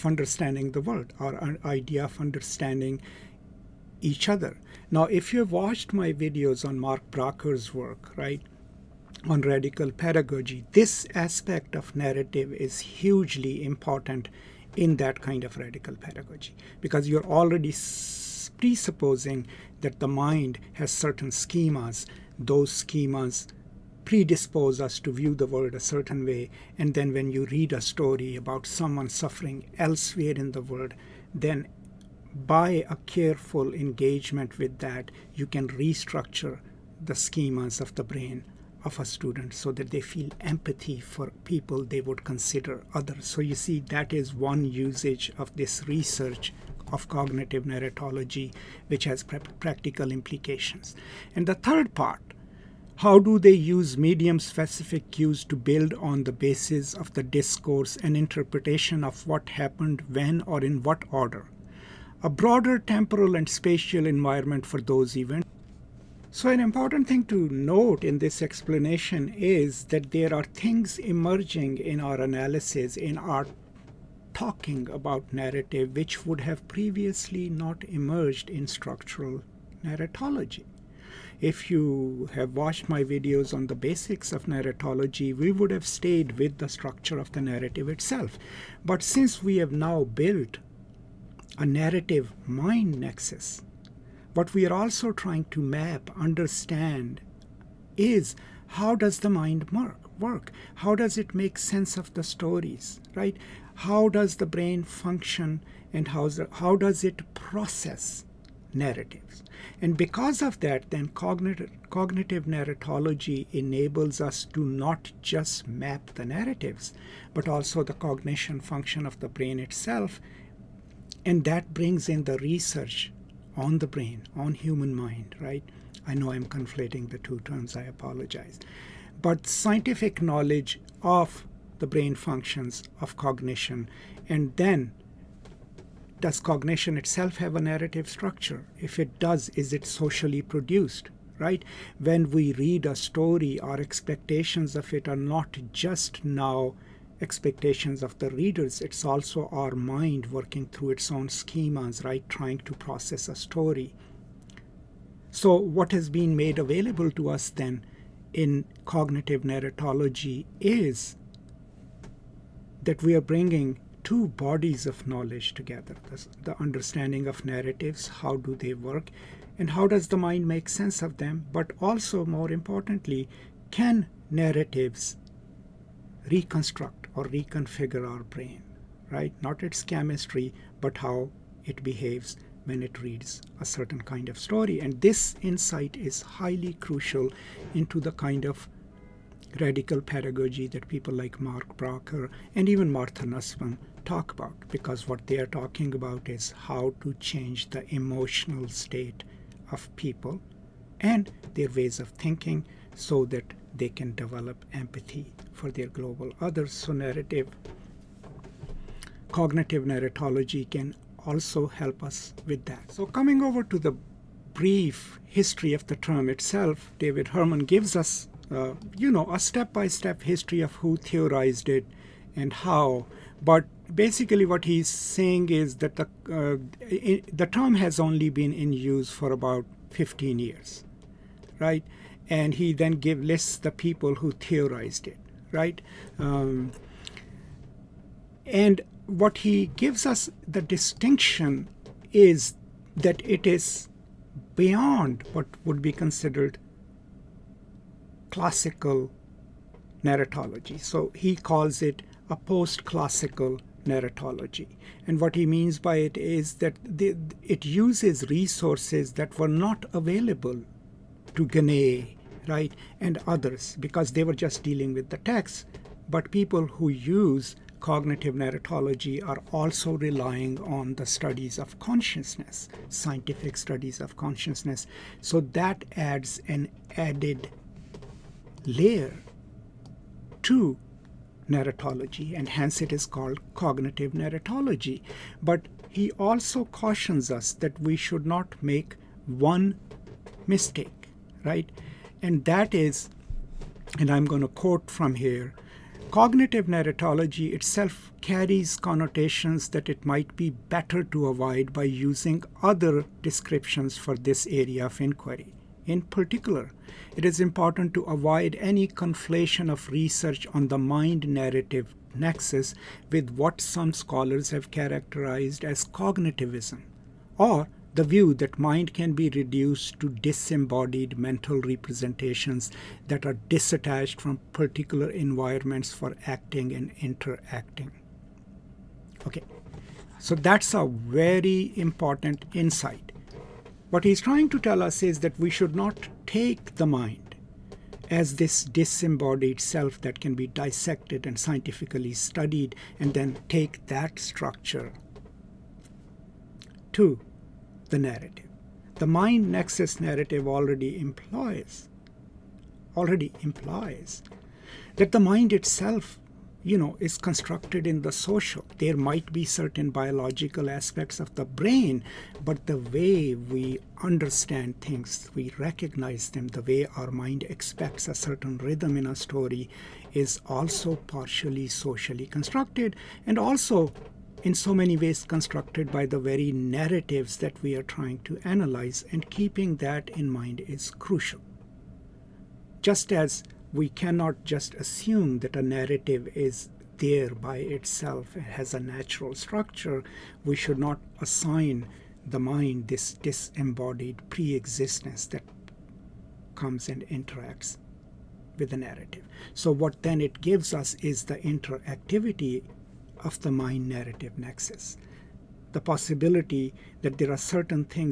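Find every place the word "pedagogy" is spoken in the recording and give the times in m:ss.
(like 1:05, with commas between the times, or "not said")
0:09, 0:15, 3:10.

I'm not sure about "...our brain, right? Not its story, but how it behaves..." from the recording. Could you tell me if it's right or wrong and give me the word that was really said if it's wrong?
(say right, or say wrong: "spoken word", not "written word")
wrong: "chemistry", not "story".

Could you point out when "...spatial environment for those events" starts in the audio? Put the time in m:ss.
1:03.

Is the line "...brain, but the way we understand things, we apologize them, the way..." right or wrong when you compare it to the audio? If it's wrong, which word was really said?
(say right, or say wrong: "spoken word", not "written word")
wrong: "recognize", not "apologize".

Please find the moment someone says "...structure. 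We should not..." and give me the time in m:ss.
6:29.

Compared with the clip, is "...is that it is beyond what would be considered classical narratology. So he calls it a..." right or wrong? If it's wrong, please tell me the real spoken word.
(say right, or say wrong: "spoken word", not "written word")
right.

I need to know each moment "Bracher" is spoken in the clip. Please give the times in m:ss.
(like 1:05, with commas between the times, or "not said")
0:07, 3:11.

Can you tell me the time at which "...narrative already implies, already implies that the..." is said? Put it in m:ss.
5:50.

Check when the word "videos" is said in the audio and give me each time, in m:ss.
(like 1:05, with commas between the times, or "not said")
0:06, 1:23.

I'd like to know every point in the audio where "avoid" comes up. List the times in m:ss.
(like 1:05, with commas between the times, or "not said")
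5:01, 5:08.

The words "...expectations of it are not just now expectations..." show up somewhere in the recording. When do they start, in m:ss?
2:23.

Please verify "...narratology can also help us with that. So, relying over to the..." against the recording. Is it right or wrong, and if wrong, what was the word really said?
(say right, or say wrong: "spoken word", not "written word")
wrong: "coming", not "relying".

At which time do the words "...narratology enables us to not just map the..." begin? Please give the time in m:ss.
1:52.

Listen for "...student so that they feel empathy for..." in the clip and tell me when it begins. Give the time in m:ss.
0:39.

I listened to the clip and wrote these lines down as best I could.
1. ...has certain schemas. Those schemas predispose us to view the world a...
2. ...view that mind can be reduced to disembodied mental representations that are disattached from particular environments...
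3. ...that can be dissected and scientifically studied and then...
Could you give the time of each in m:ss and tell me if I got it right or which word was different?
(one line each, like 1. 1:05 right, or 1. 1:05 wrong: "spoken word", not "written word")
1. 0:20 right
2. 5:18 right
3. 5:40 right.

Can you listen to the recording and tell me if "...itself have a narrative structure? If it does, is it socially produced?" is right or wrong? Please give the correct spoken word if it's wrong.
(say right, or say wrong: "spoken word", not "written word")
right.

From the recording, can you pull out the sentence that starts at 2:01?
And that brings in the research on the brain, on human mind, right?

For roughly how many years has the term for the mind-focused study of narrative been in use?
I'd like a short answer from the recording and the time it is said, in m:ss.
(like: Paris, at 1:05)
15 years, at 3:49.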